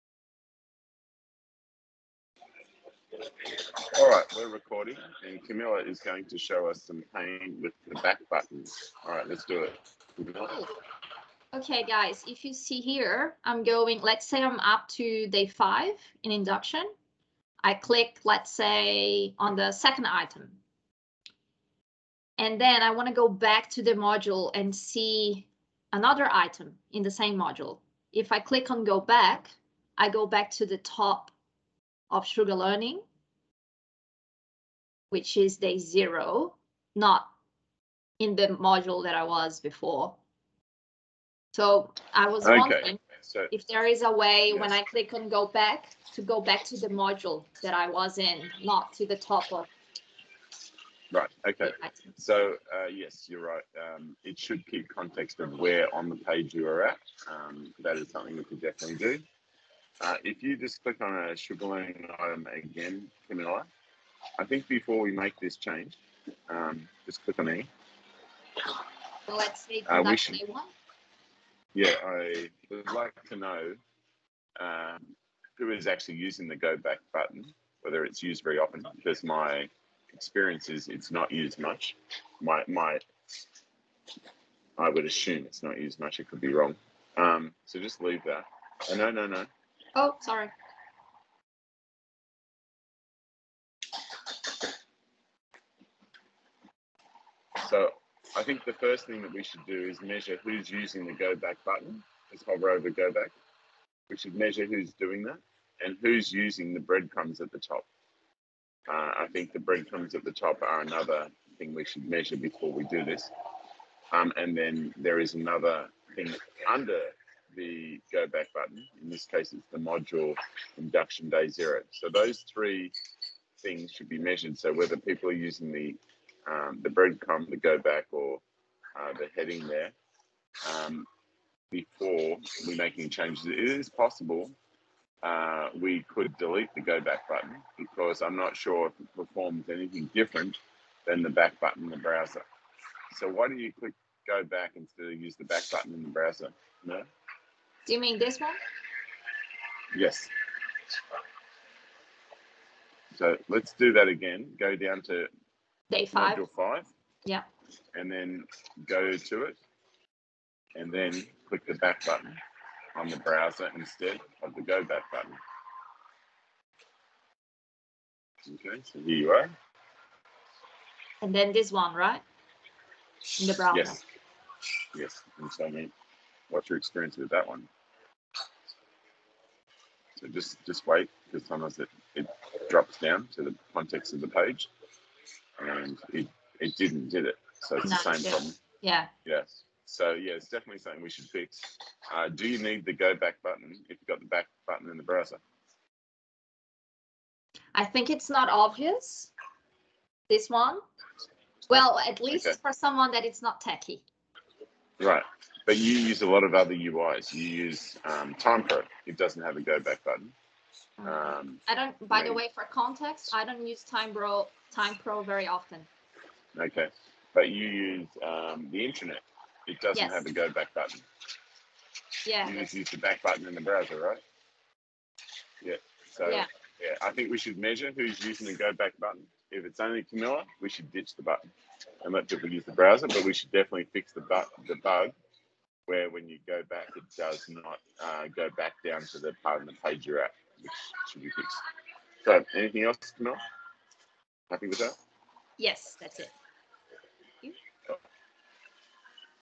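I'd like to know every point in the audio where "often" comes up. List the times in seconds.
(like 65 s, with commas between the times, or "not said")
78 s, 215 s.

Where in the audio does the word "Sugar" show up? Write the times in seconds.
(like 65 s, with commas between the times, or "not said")
32 s, 61 s.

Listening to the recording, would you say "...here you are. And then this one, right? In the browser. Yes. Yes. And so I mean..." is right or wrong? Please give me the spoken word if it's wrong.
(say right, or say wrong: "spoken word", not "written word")
right.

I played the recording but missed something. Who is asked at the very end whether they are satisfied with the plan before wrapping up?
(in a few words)
Mel.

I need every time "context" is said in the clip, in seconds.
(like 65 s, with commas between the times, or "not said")
54 s, 183 s, 212 s.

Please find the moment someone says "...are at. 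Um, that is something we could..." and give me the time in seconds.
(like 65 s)
56 s.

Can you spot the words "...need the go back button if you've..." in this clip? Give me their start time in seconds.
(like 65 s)
192 s.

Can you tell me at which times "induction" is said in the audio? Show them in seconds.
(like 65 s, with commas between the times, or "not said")
16 s, 120 s.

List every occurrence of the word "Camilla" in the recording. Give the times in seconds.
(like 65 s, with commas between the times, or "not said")
5 s, 10 s, 63 s, 230 s.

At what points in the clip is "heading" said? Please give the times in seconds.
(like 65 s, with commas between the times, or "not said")
129 s.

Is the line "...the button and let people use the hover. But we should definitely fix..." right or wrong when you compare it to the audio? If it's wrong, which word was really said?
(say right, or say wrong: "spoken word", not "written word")
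wrong: "browser", not "hover".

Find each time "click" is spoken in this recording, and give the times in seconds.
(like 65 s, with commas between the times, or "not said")
17 s, 28 s, 44 s, 60 s, 67 s, 143 s, 161 s.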